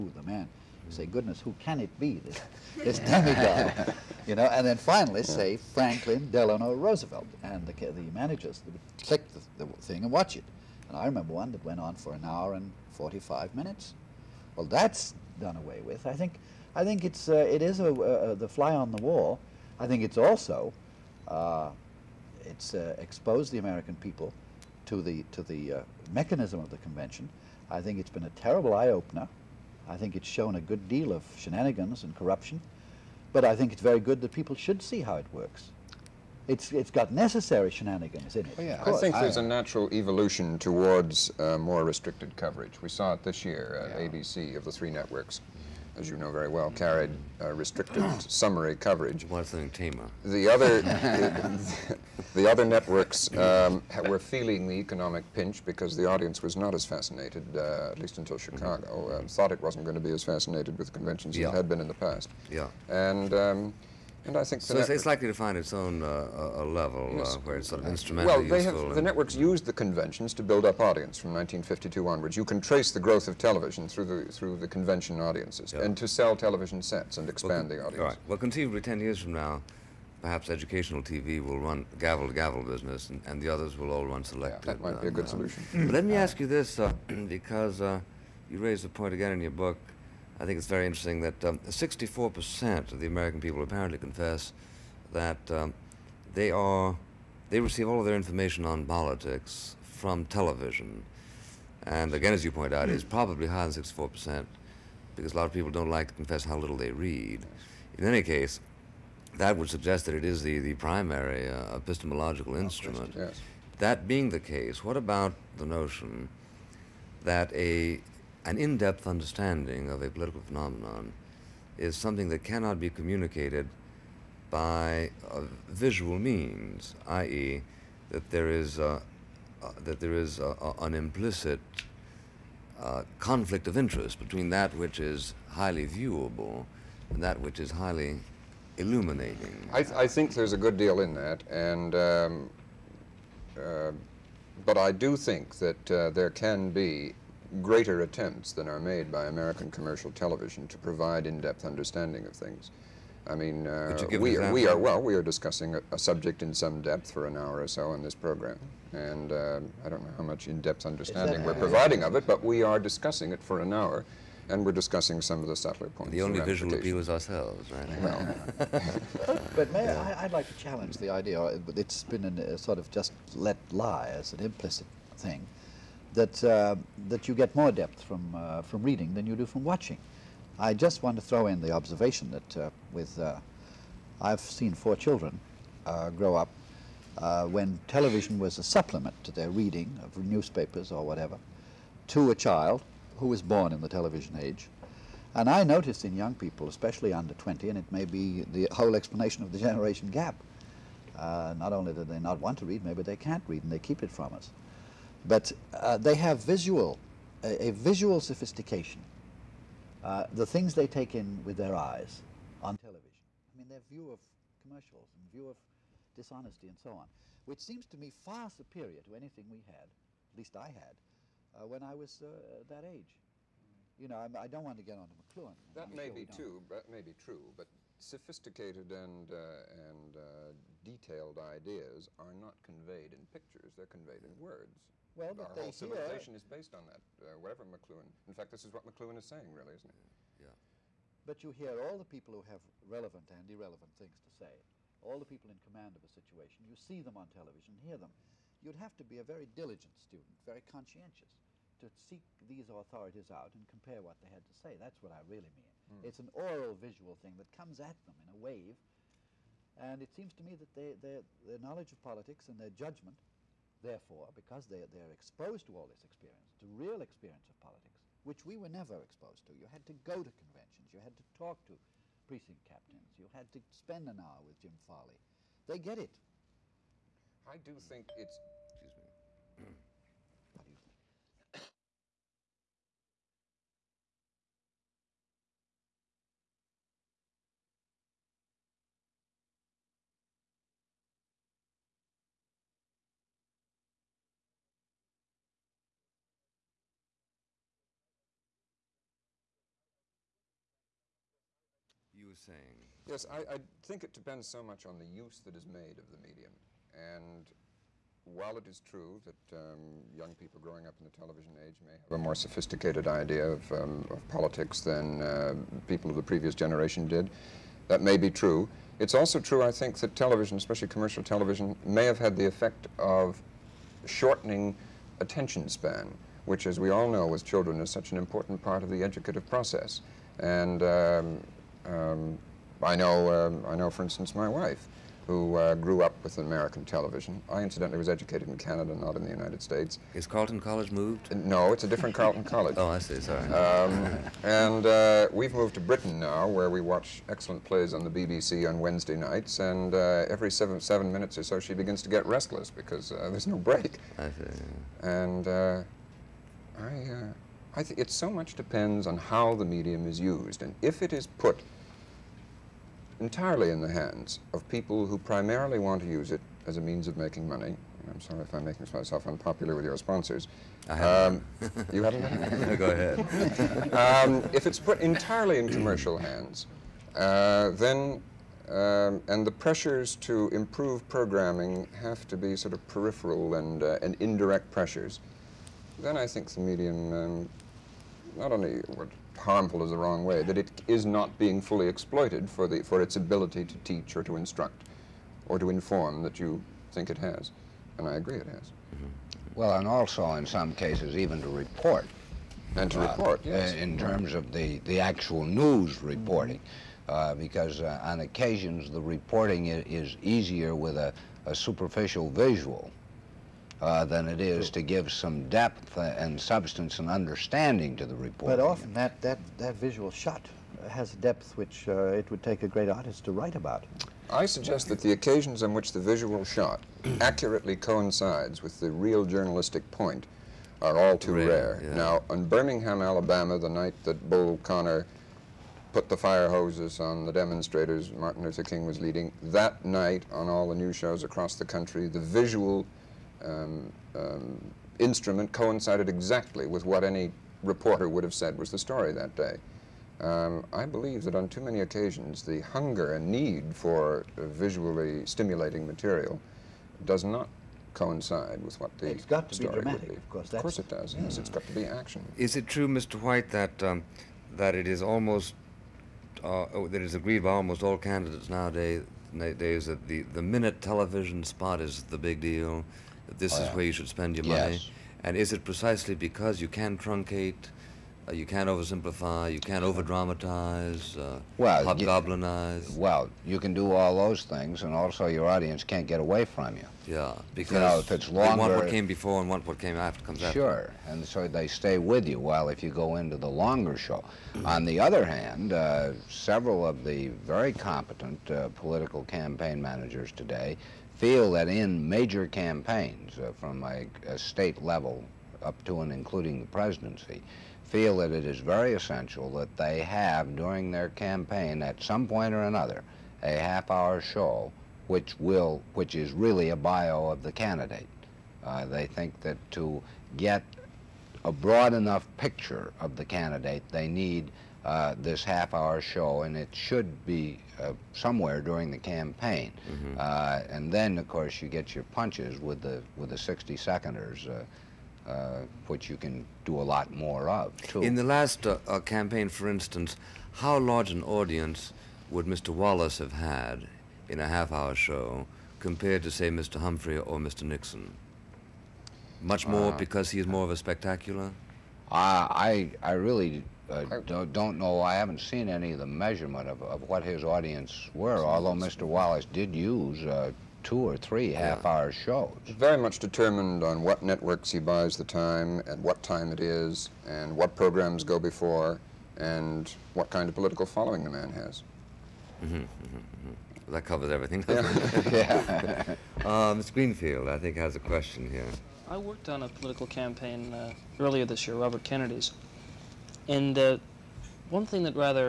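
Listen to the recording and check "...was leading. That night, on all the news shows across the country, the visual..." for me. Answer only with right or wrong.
right.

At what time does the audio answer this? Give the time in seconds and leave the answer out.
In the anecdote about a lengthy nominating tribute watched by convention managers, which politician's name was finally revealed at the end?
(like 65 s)
5 s.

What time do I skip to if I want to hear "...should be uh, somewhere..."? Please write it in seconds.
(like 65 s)
526 s.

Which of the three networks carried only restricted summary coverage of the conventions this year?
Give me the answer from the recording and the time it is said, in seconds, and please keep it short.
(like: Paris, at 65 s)
ABC, at 44 s.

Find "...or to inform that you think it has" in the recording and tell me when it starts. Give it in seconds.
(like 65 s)
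395 s.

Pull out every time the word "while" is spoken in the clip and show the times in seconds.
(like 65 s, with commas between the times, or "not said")
308 s, 492 s.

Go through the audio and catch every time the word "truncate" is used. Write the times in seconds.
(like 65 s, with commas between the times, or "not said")
476 s.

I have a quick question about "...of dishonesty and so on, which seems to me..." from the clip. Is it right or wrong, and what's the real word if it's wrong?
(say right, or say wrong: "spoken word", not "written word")
right.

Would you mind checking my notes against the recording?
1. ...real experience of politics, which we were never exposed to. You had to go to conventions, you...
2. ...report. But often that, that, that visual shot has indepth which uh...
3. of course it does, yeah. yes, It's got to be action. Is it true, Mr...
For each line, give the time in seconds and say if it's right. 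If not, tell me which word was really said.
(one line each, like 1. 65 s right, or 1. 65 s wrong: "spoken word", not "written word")
1. 266 s right
2. 418 s wrong: "depth", not "indepth"
3. 460 s right.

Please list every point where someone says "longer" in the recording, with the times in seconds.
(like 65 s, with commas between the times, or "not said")
488 s, 493 s.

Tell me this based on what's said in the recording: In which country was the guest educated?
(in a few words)
Canada.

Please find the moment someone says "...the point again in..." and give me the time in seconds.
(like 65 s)
88 s.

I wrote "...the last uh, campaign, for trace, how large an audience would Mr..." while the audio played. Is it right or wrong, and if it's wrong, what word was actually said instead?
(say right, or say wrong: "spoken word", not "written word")
wrong: "instance", not "trace".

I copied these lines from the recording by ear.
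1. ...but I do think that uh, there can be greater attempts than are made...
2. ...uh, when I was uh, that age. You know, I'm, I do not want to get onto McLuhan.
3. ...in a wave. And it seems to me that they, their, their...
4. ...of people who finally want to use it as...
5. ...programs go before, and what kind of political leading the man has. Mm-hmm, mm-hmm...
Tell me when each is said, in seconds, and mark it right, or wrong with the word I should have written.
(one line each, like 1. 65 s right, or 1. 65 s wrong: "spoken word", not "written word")
1. 144 s right
2. 221 s right
3. 258 s right
4. 364 s wrong: "primarily", not "finally"
5. 567 s wrong: "following", not "leading".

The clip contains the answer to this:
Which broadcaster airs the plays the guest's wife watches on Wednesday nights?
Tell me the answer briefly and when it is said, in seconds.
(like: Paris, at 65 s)
BBC, at 348 s.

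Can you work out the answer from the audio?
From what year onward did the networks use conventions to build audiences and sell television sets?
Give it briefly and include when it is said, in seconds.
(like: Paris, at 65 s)
1952, at 71 s.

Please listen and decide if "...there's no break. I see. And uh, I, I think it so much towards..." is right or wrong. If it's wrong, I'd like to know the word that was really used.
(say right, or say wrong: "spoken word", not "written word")
wrong: "depends", not "towards".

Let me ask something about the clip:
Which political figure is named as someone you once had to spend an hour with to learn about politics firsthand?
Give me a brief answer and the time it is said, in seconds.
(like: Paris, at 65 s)
Jim Farley, at 274 s.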